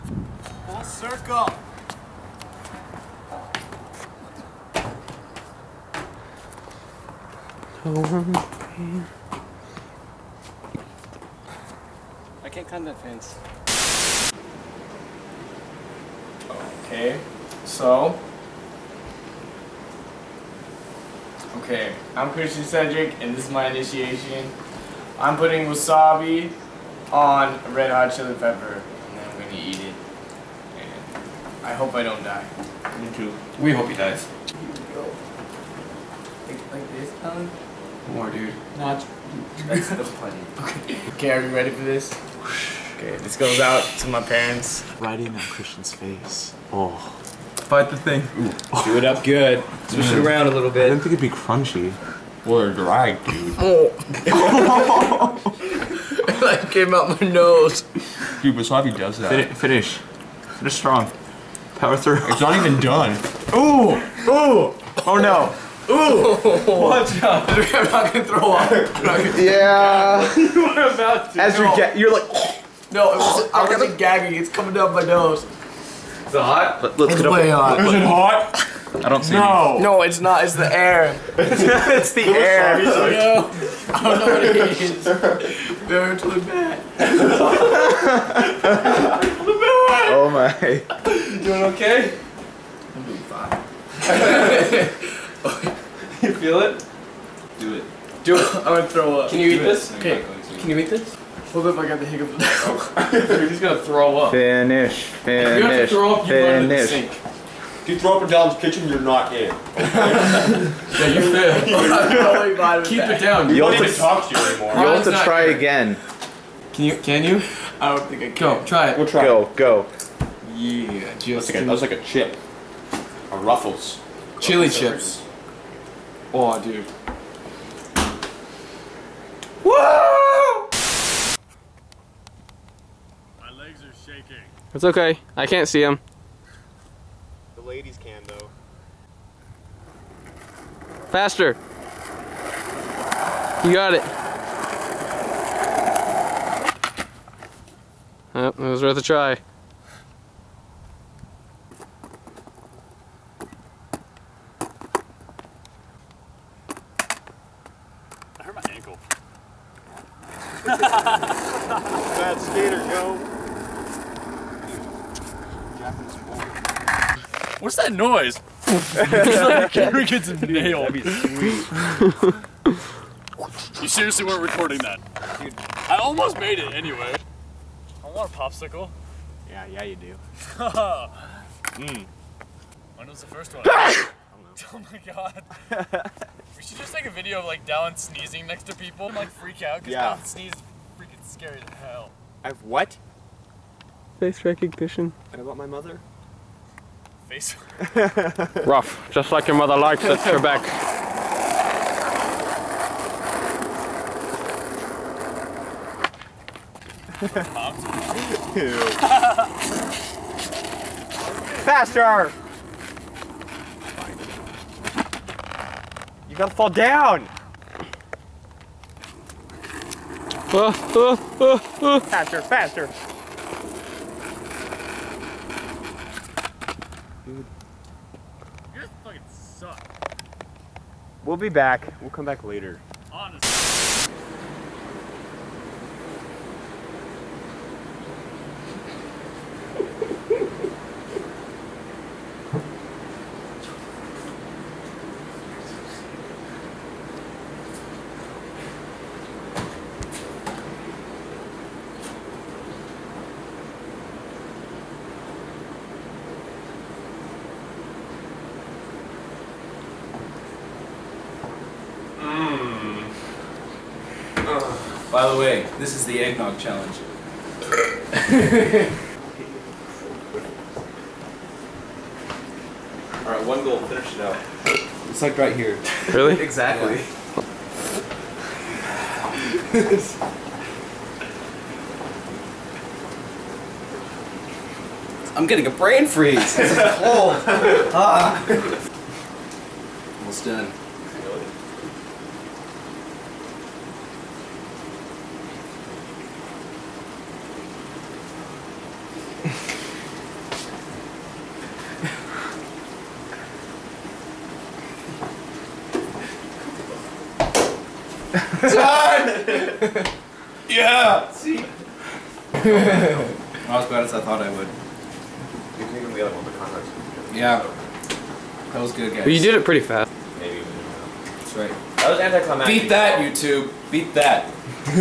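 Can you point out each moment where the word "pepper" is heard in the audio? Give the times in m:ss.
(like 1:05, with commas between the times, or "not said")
0:28.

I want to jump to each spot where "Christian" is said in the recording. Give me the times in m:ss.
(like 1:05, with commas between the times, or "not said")
0:22, 0:45.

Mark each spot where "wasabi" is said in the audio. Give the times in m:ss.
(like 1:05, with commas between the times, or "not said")
0:25, 0:58.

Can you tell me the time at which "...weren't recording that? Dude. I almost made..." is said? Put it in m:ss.
2:54.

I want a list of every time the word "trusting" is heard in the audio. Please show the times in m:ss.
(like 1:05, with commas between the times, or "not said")
not said.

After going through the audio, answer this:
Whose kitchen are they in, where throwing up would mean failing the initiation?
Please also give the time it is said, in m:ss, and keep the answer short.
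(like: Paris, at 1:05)
Dom's, at 1:48.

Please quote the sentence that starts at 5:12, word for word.
Not as bad as I thought I would.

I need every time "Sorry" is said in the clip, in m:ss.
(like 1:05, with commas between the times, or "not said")
1:22.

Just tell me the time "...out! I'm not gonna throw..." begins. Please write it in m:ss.
1:07.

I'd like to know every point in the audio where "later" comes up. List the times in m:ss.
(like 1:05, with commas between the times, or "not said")
3:52.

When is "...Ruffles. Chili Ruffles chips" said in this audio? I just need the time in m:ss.
2:03.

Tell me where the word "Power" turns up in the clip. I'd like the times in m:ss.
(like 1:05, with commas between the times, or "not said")
1:01.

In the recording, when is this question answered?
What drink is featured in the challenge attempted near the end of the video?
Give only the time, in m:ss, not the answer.
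4:26.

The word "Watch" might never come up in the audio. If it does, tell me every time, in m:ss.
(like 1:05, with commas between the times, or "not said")
1:06.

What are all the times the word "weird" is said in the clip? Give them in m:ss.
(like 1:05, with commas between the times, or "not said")
not said.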